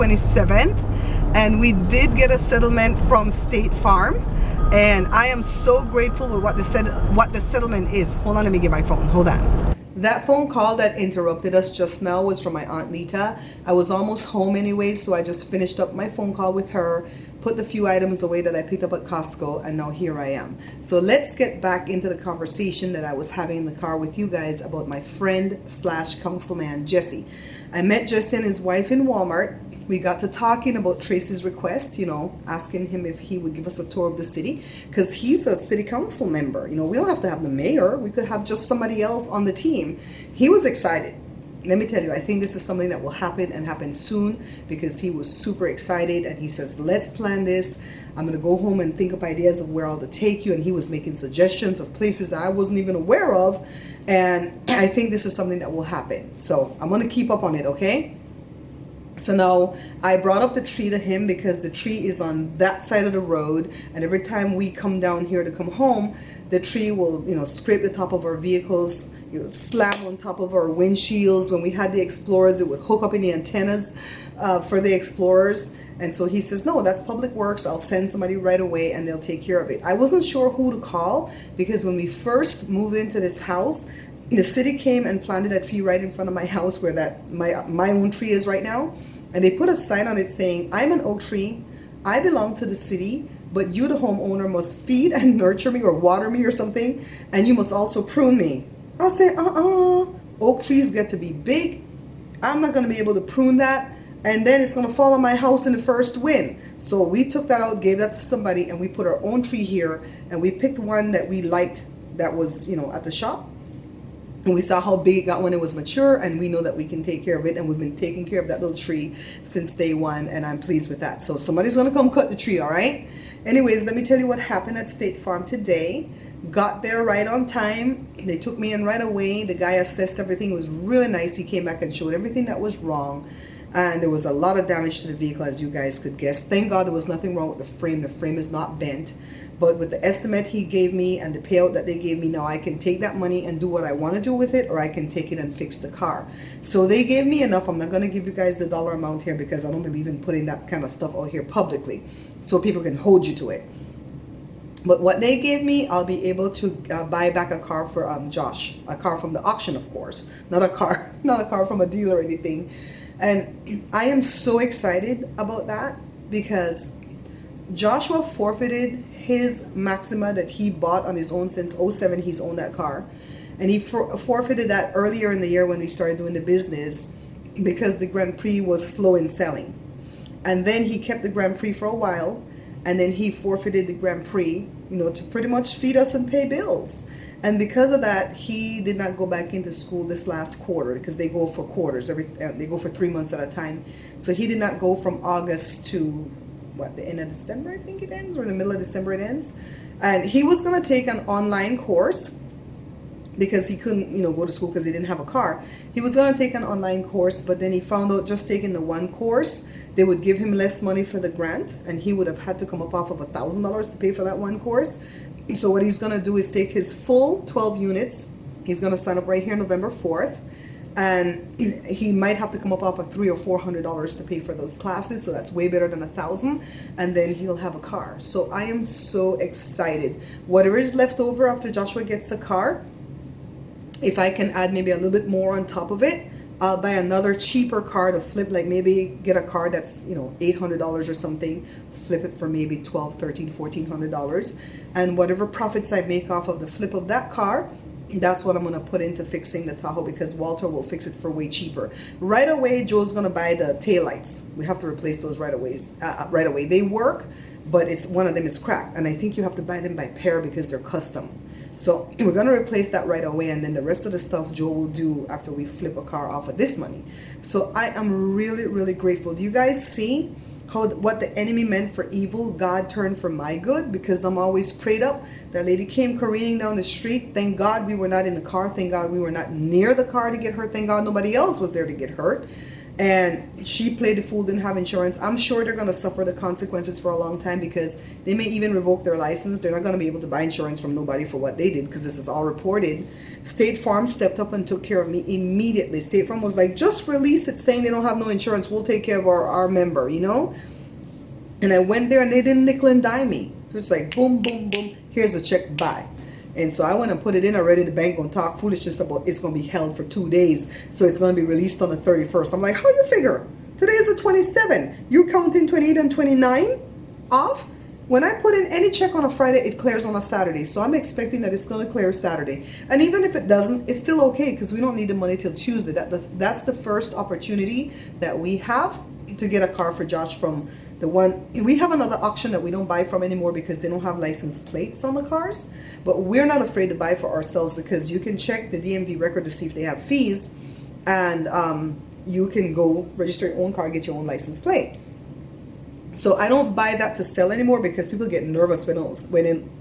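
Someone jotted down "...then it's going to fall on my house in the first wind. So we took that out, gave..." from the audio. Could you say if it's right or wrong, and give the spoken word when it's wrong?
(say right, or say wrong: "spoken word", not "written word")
right.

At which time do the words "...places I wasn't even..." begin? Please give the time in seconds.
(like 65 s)
51 s.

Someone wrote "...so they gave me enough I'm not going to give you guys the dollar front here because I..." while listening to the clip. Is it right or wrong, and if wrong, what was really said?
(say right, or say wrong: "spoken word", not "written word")
wrong: "amount", not "front".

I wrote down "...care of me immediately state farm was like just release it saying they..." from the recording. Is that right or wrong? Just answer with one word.
right.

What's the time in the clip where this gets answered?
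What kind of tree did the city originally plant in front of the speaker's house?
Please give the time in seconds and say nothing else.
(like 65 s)
91 s.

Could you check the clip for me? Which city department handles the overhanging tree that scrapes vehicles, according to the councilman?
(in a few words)
Public Works.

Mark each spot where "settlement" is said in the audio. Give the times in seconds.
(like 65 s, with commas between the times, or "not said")
2 s, 7 s.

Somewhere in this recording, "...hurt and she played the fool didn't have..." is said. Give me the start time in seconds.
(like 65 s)
282 s.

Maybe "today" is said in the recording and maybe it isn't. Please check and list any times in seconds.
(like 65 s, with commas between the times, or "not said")
125 s, 313 s.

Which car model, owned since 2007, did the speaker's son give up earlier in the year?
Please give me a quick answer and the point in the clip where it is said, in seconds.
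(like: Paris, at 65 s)
Maxima, at 169 s.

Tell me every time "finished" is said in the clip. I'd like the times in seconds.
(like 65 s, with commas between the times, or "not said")
15 s.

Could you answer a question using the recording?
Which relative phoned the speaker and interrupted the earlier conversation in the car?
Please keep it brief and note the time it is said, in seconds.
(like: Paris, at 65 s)
Aunt Lita, at 12 s.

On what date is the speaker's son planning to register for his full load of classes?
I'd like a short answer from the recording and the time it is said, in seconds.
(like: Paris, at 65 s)
November 4, at 219 s.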